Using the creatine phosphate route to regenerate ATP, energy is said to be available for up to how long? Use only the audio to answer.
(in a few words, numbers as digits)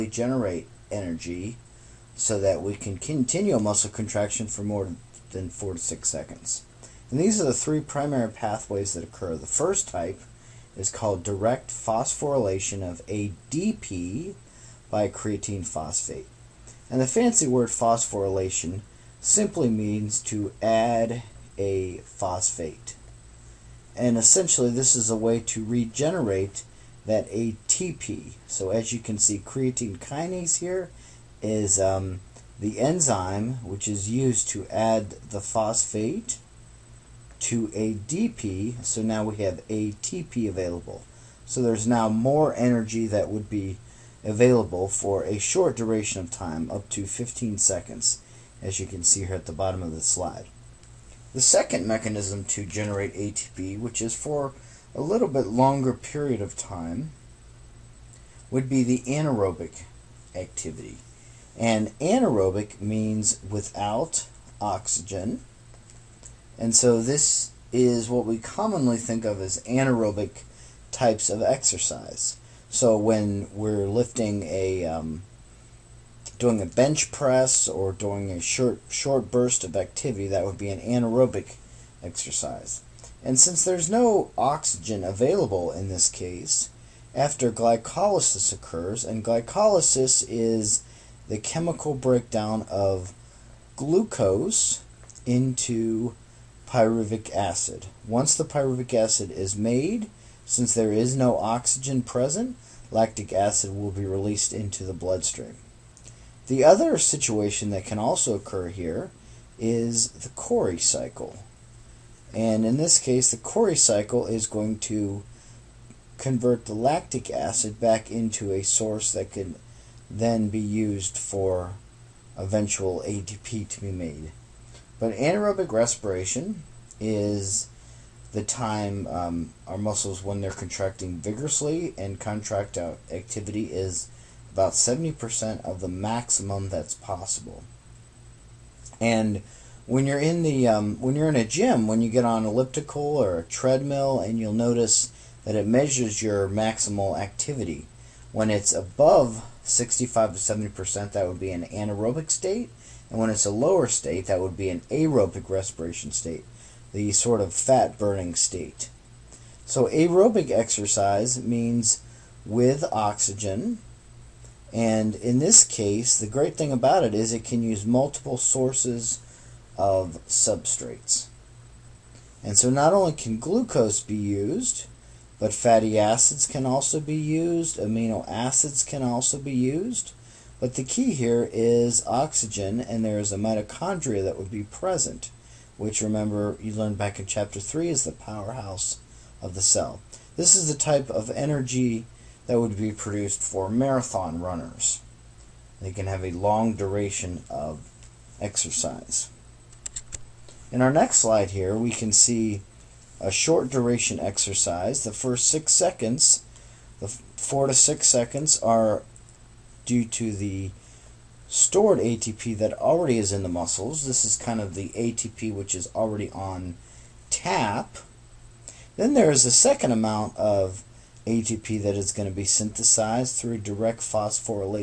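15 seconds.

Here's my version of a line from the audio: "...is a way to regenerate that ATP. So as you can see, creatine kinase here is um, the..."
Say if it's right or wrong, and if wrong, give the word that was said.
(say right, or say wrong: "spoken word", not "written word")
right.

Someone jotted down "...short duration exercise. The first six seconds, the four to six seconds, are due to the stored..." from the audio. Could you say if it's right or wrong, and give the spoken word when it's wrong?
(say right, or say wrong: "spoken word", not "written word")
right.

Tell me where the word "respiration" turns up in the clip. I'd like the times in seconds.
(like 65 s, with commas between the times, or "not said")
125 s, 155 s.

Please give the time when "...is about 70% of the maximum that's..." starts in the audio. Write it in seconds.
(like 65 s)
133 s.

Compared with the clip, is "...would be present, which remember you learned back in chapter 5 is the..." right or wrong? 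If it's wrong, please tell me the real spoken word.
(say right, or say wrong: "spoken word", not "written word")
wrong: "3", not "5".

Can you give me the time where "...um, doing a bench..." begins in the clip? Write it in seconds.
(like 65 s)
74 s.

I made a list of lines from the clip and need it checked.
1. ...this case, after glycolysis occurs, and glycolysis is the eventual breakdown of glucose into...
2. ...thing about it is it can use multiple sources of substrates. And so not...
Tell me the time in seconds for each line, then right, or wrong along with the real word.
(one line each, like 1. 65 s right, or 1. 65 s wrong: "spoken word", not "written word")
1. 85 s wrong: "chemical", not "eventual"
2. 166 s right.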